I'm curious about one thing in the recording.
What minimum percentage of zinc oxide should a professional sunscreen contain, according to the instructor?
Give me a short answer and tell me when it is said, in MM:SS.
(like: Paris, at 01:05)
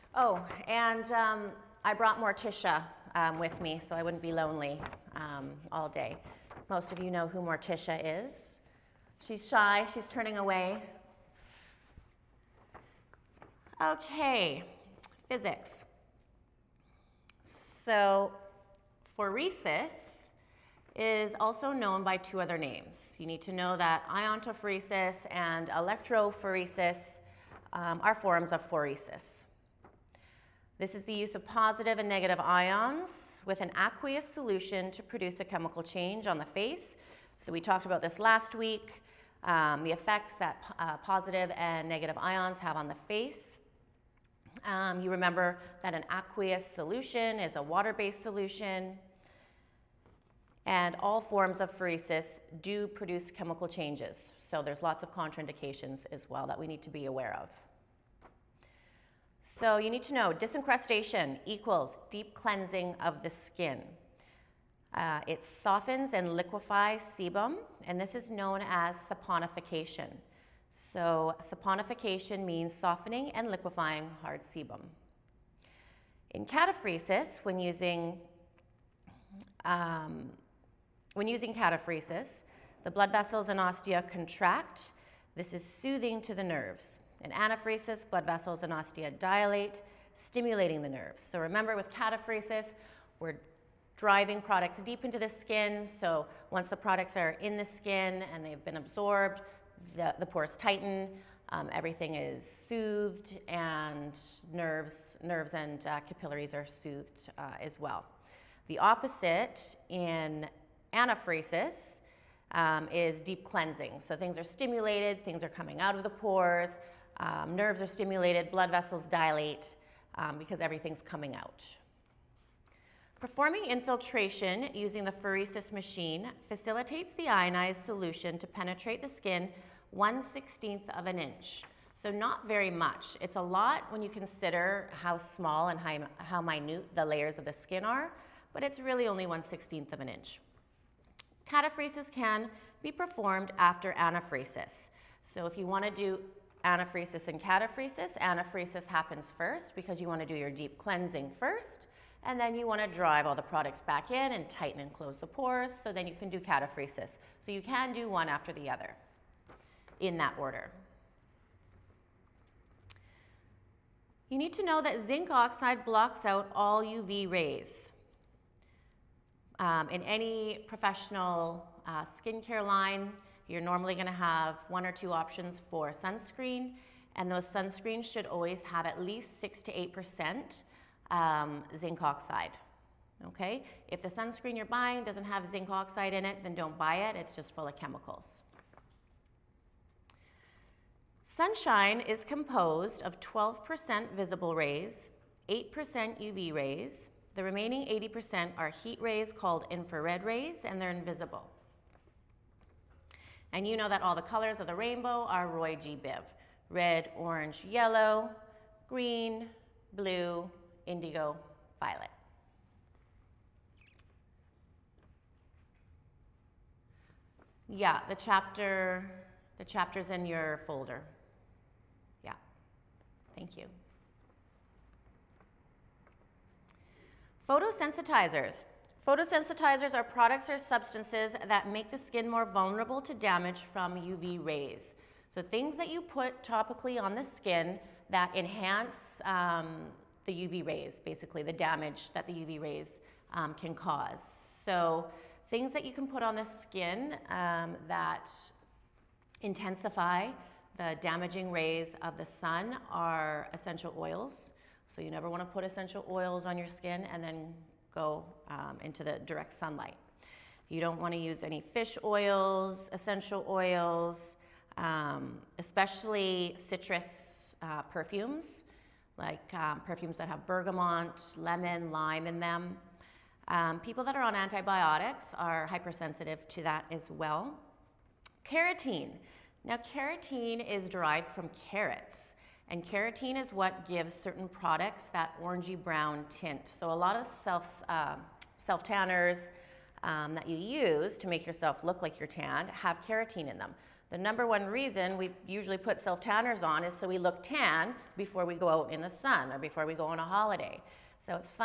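6 to 8%, at 02:59.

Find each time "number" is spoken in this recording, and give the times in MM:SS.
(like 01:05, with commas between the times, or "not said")
04:54.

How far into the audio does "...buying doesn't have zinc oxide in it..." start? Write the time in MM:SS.
03:04.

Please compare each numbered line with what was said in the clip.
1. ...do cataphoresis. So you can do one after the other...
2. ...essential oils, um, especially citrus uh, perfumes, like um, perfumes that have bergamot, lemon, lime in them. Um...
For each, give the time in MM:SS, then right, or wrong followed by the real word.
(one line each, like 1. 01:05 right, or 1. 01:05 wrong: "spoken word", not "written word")
1. 02:36 right
2. 04:22 right.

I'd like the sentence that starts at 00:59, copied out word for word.
So you need to know disincrustation equals deep cleansing of the skin.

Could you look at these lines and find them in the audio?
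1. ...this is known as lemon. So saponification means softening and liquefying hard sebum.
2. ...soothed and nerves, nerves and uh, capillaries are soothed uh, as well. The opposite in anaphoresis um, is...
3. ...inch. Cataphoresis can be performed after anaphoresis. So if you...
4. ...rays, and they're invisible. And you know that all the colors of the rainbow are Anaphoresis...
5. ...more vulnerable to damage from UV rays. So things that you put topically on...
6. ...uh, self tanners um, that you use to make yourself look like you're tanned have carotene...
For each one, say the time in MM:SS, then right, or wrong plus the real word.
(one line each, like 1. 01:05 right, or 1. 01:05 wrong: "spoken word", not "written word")
1. 01:08 wrong: "saponification", not "lemon"
2. 01:42 right
3. 02:20 right
4. 03:20 wrong: "Roy", not "Anaphoresis"
5. 03:52 right
6. 04:47 right.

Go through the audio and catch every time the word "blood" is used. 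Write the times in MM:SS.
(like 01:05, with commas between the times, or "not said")
01:22, 01:28, 01:58.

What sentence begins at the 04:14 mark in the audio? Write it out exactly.
So you never want to put essential oils on your skin and then go um, into the direct sunlight.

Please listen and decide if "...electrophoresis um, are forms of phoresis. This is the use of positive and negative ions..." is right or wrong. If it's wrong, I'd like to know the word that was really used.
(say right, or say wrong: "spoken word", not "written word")
right.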